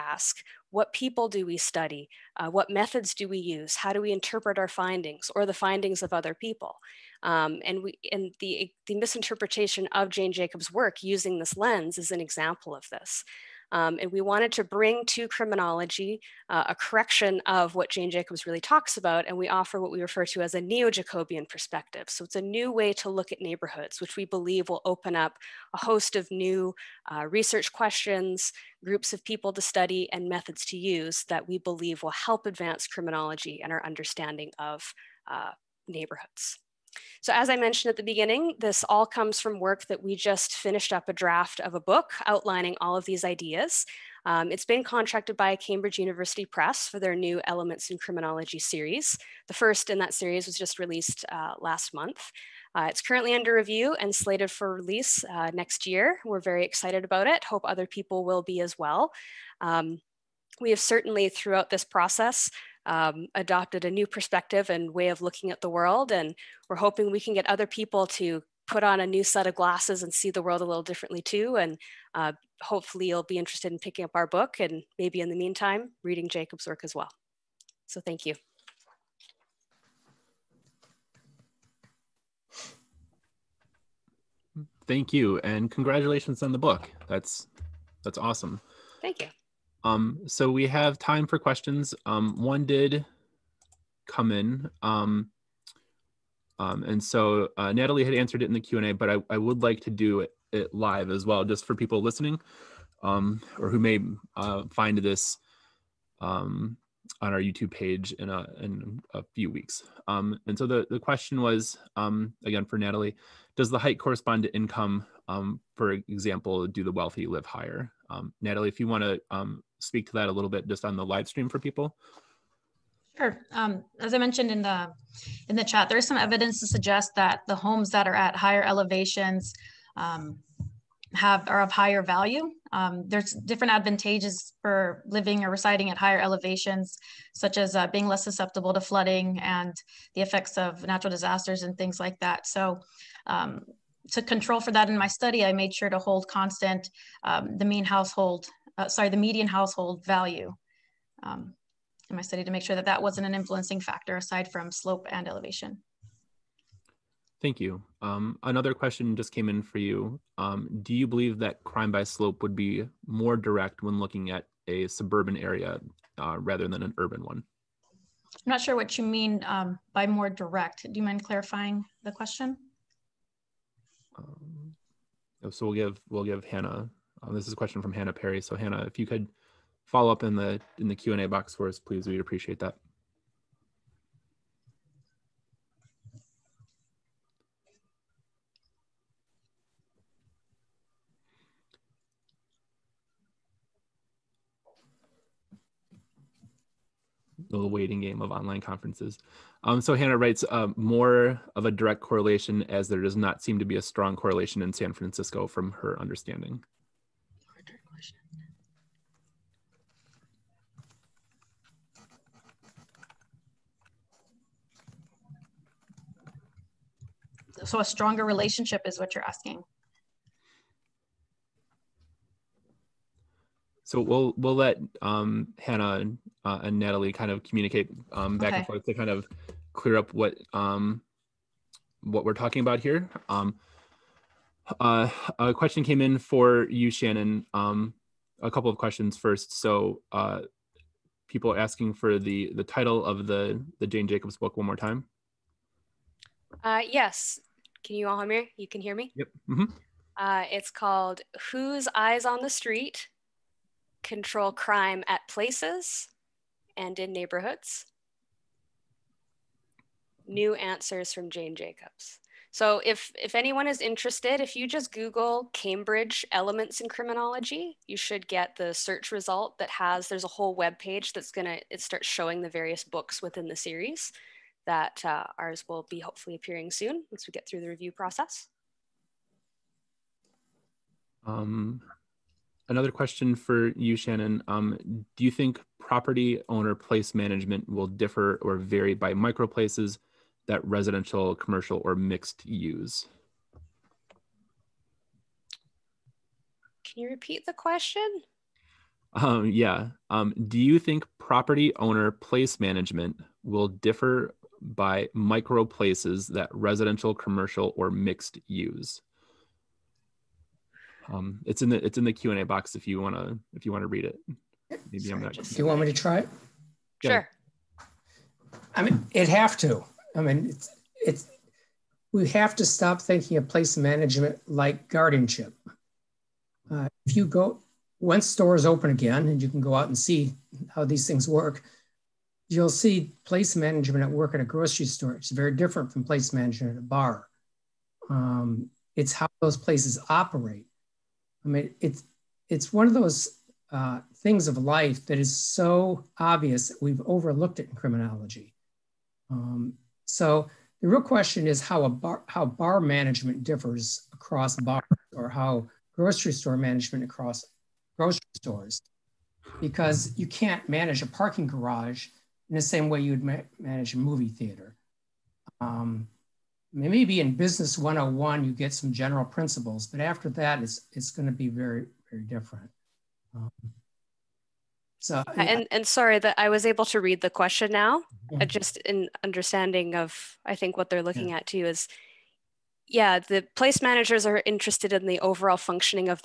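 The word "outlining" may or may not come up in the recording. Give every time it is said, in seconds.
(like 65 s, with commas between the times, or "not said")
42 s.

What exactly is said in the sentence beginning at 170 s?
Do you mind clarifying the question?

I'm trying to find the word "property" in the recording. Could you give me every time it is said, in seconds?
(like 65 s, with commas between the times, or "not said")
285 s, 301 s.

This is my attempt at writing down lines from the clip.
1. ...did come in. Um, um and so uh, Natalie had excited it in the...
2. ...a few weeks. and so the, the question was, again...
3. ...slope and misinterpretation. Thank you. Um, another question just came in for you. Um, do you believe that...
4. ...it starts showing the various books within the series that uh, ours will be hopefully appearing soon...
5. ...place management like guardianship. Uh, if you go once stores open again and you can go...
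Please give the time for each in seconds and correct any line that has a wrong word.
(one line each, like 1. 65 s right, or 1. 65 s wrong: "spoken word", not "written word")
1. 92 s wrong: "answered", not "excited"
2. 109 s right
3. 154 s wrong: "elevation", not "misinterpretation"
4. 271 s right
5. 323 s right.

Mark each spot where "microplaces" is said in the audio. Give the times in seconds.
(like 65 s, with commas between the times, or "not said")
289 s, 305 s.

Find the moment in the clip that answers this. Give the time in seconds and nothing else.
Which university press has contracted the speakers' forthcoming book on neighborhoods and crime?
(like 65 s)
45 s.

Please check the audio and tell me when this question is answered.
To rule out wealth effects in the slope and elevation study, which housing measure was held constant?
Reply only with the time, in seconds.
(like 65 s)
149 s.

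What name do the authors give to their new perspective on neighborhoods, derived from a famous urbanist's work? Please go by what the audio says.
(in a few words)
neo Jacobian perspective.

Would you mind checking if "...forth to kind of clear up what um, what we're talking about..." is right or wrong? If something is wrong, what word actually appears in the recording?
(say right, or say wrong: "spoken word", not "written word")
right.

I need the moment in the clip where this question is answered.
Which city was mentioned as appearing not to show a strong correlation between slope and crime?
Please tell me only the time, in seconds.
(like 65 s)
204 s.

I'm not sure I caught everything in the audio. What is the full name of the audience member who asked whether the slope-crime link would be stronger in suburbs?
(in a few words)
Hannah Perry.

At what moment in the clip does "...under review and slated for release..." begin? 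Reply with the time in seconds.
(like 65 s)
53 s.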